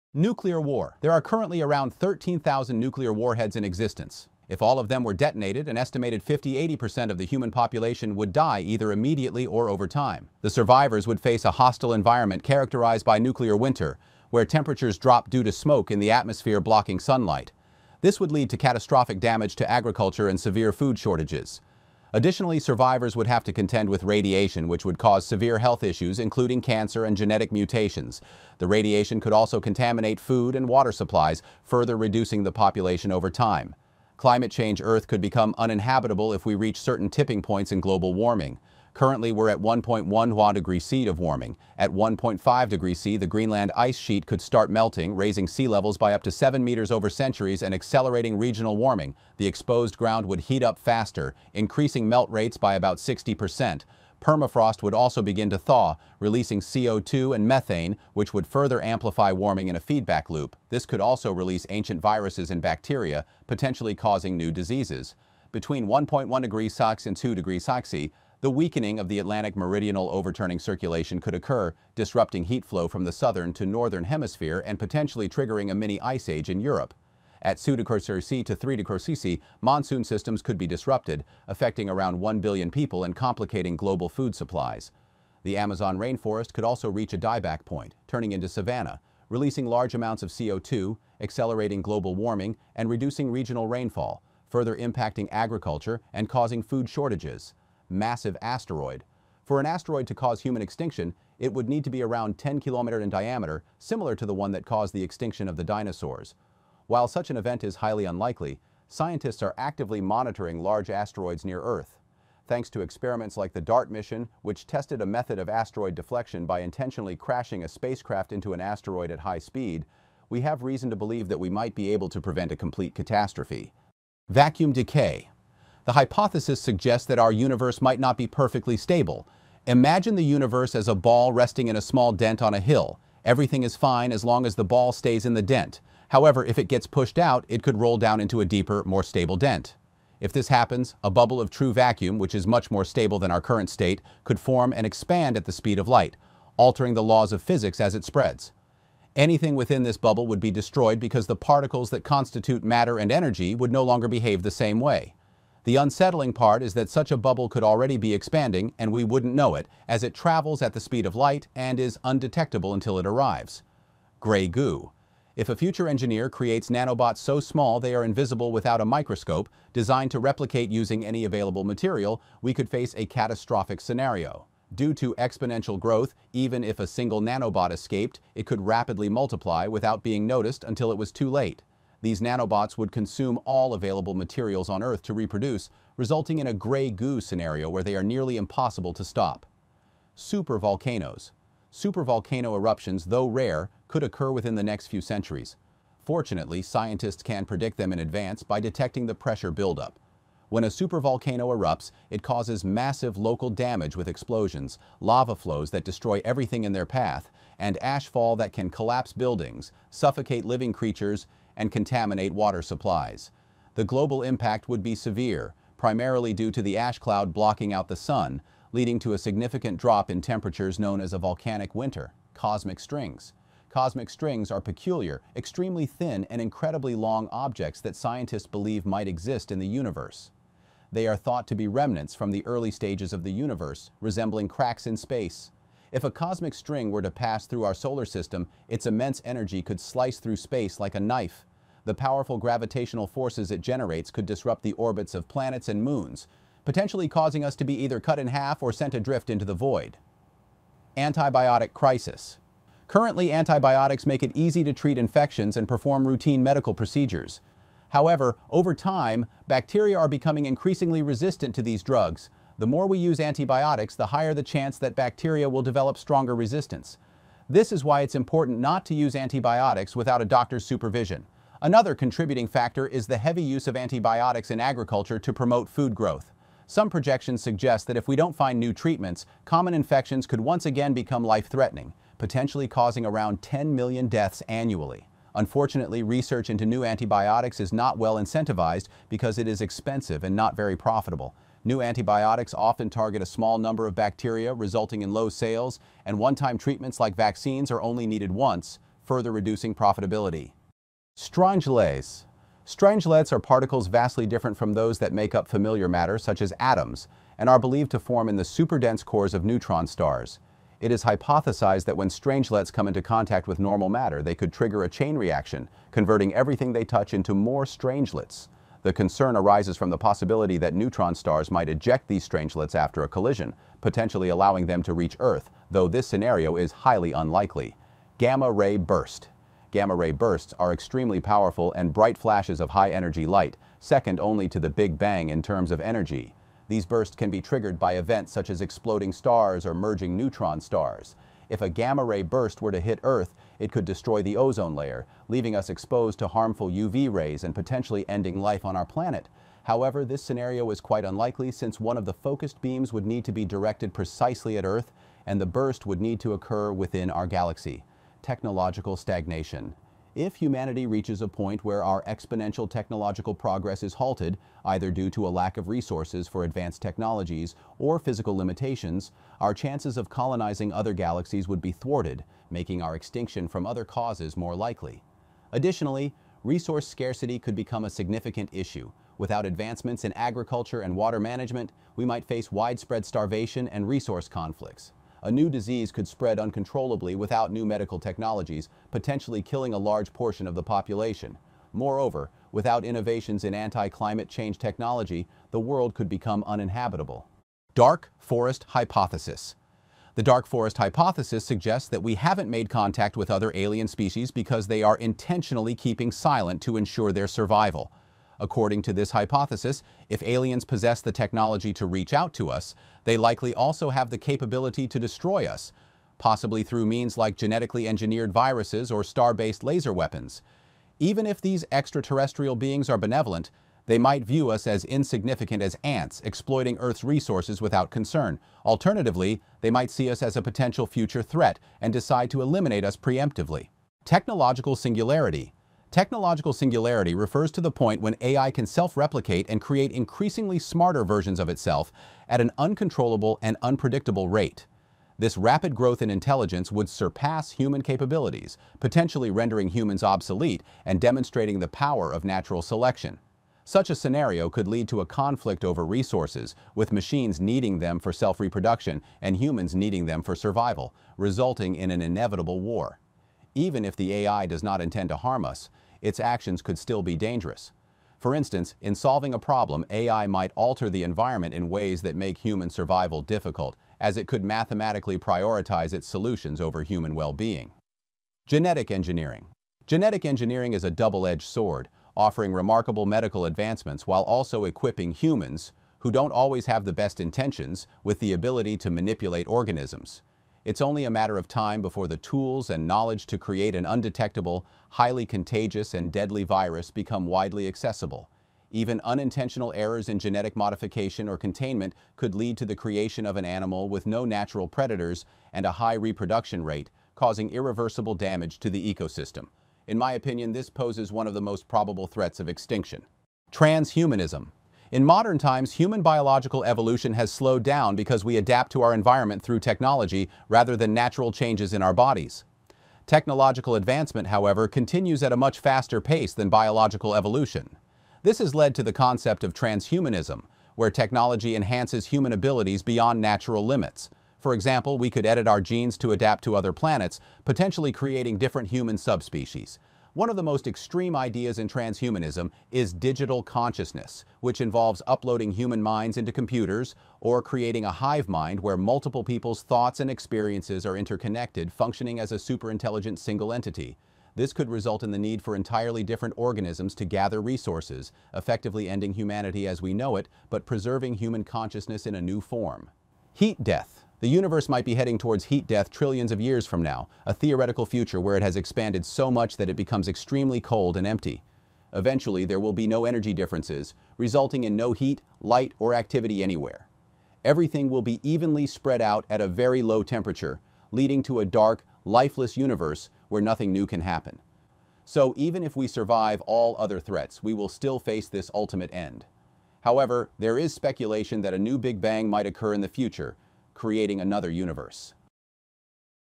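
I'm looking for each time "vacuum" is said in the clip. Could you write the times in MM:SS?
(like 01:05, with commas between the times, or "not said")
02:04, 02:21.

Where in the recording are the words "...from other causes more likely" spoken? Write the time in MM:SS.
06:13.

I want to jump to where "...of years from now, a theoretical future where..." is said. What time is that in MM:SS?
09:26.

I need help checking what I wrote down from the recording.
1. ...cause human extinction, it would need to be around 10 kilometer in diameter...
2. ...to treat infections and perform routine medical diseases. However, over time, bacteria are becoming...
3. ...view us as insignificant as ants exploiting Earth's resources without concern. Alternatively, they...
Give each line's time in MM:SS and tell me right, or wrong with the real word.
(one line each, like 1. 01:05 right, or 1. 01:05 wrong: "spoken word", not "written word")
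1. 01:40 right
2. 04:14 wrong: "procedures", not "diseases"
3. 07:04 right.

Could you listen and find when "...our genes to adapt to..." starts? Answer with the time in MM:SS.
08:55.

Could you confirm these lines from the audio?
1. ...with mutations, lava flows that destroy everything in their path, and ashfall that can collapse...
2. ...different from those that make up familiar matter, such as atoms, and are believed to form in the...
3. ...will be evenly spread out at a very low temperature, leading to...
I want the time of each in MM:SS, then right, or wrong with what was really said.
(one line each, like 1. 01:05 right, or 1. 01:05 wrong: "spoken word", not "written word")
1. 03:23 wrong: "explosions", not "mutations"
2. 05:04 right
3. 09:37 right.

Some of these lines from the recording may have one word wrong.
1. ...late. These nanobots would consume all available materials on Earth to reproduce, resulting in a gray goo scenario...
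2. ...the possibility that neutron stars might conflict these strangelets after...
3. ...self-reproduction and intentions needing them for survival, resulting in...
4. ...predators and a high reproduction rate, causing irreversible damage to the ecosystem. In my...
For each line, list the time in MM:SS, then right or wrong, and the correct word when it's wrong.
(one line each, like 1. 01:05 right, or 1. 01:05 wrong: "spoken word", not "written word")
1. 03:01 right
2. 05:19 wrong: "eject", not "conflict"
3. 07:38 wrong: "humans", not "intentions"
4. 08:24 right.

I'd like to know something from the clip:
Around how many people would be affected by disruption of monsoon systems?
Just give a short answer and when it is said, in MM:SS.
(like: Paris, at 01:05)
1 billion, at 01:22.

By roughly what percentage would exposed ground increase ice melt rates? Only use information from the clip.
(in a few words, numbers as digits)
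60 percent.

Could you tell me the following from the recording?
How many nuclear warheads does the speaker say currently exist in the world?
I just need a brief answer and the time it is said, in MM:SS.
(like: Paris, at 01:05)
13,000, at 00:01.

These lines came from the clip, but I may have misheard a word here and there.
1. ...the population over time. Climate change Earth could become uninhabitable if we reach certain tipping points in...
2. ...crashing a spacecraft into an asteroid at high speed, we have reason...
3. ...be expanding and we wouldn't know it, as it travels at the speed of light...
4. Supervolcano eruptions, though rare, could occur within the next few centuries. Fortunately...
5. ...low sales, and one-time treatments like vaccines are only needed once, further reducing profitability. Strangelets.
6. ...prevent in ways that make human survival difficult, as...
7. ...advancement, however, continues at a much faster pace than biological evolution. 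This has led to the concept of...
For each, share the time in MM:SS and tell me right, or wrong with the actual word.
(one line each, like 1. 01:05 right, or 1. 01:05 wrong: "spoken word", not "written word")
1. 00:32 right
2. 01:57 right
3. 02:37 right
4. 03:11 right
5. 04:55 right
6. 07:51 wrong: "environment", not "prevent"
7. 08:43 right.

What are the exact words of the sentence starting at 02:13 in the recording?
Everything is fine as long as the ball stays in the dent.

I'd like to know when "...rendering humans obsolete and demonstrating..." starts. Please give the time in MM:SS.
07:29.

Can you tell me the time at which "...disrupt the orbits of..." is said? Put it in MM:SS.
04:04.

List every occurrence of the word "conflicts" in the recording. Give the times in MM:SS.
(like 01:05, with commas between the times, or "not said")
06:24, 07:35.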